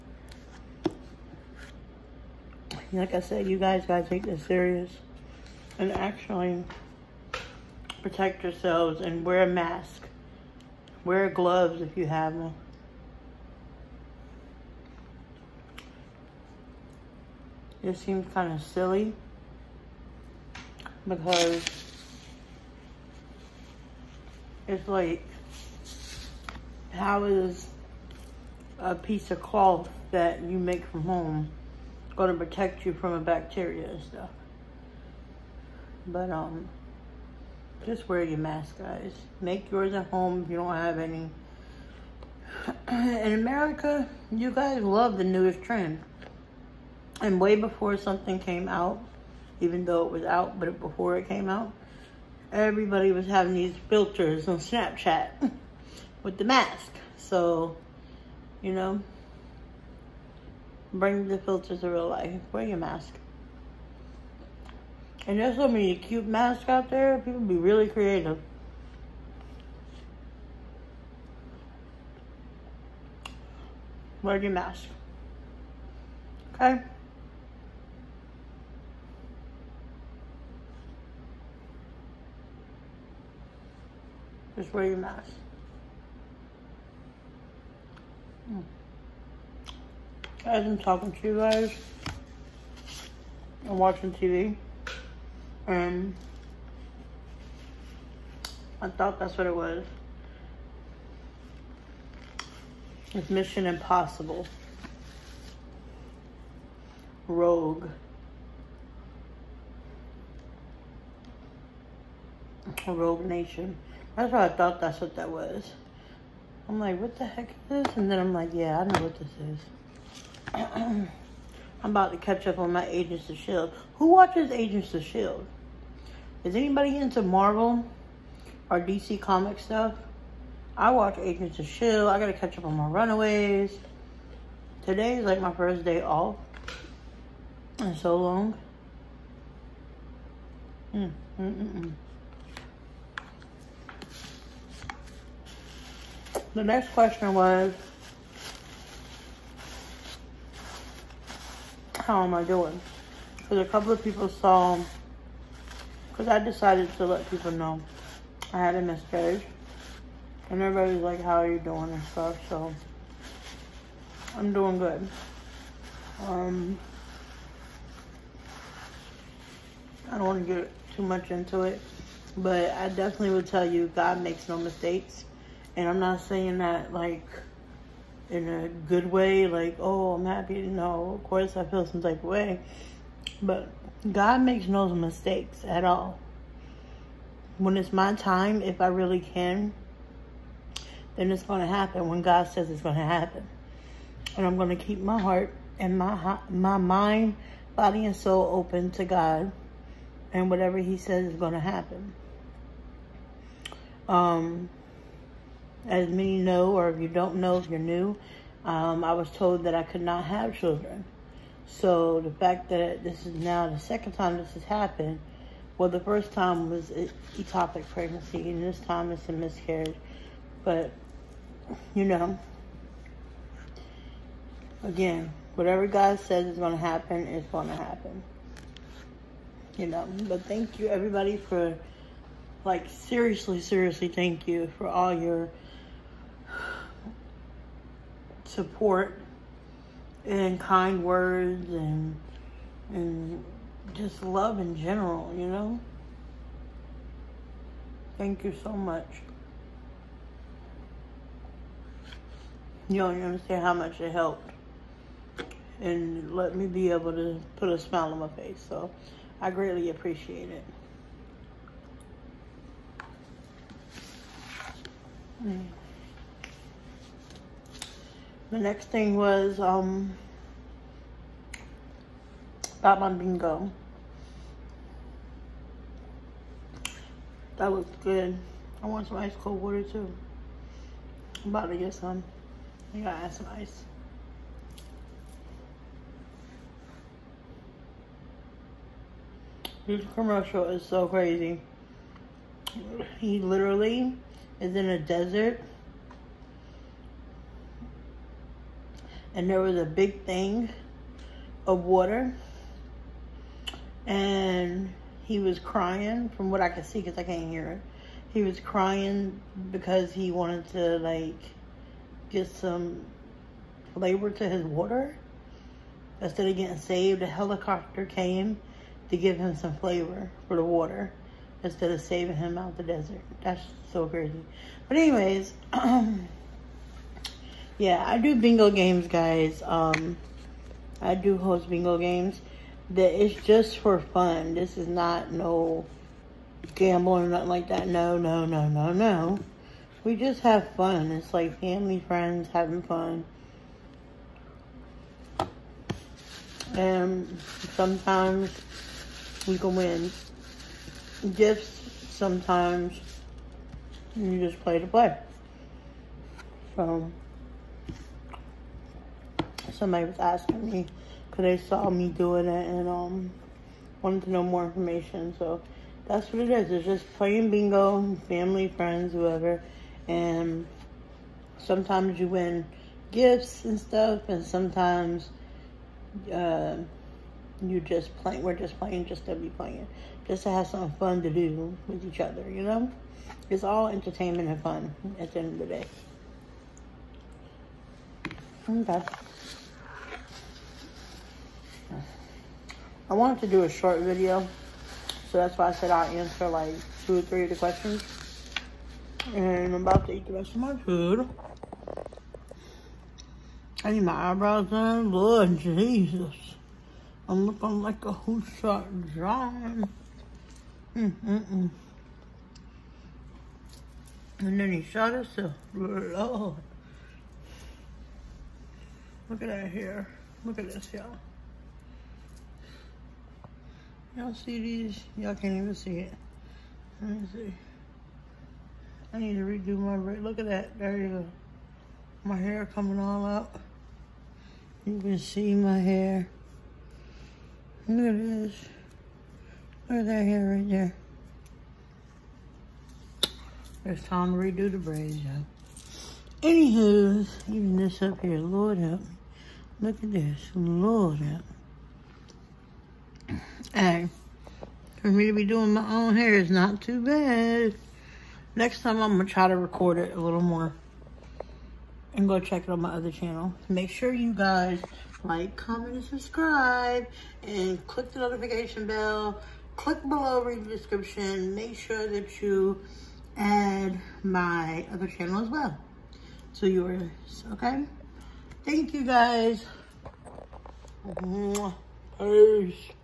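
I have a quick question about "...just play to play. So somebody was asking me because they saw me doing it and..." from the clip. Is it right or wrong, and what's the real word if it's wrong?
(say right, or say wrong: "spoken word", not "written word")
right.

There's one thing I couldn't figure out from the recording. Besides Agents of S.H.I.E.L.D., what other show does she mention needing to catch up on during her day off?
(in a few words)
Runaways.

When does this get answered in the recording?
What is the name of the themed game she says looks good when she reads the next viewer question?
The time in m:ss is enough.
4:32.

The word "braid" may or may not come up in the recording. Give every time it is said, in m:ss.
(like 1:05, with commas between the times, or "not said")
7:09, 7:24.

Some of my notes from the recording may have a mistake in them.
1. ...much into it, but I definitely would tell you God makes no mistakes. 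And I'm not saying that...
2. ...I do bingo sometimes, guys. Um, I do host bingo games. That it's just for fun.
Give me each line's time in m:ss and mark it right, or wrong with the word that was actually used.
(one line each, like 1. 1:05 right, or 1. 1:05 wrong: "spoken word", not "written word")
1. 2:51 right
2. 5:28 wrong: "games", not "sometimes".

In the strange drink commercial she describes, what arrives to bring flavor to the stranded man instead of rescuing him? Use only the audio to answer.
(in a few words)
A helicopter.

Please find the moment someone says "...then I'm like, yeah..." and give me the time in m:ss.
1:58.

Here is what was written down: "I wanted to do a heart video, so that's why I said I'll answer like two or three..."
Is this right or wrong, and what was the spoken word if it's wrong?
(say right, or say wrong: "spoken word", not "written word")
wrong: "short", not "heart".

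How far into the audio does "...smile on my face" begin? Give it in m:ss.
4:17.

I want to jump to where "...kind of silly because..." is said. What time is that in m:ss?
0:18.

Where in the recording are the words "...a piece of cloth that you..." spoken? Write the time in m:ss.
0:28.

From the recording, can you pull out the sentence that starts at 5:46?
And sometimes we can win gifts.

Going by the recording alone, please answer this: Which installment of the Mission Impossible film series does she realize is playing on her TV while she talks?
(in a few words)
Rogue Nation.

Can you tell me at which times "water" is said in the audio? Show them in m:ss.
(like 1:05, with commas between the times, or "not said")
4:39, 5:01, 5:14, 5:20.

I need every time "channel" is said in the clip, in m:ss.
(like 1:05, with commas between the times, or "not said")
7:43, 7:55.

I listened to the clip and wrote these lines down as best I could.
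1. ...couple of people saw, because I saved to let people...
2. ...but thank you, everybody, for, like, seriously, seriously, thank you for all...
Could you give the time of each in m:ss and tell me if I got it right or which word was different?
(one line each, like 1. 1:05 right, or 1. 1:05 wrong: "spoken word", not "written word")
1. 2:33 wrong: "decided", not "saved"
2. 3:50 right.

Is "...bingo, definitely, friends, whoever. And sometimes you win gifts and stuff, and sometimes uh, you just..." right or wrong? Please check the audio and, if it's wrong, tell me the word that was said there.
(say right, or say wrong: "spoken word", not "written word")
wrong: "family", not "definitely".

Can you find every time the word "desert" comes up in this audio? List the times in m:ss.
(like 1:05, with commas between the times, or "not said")
4:54, 5:22.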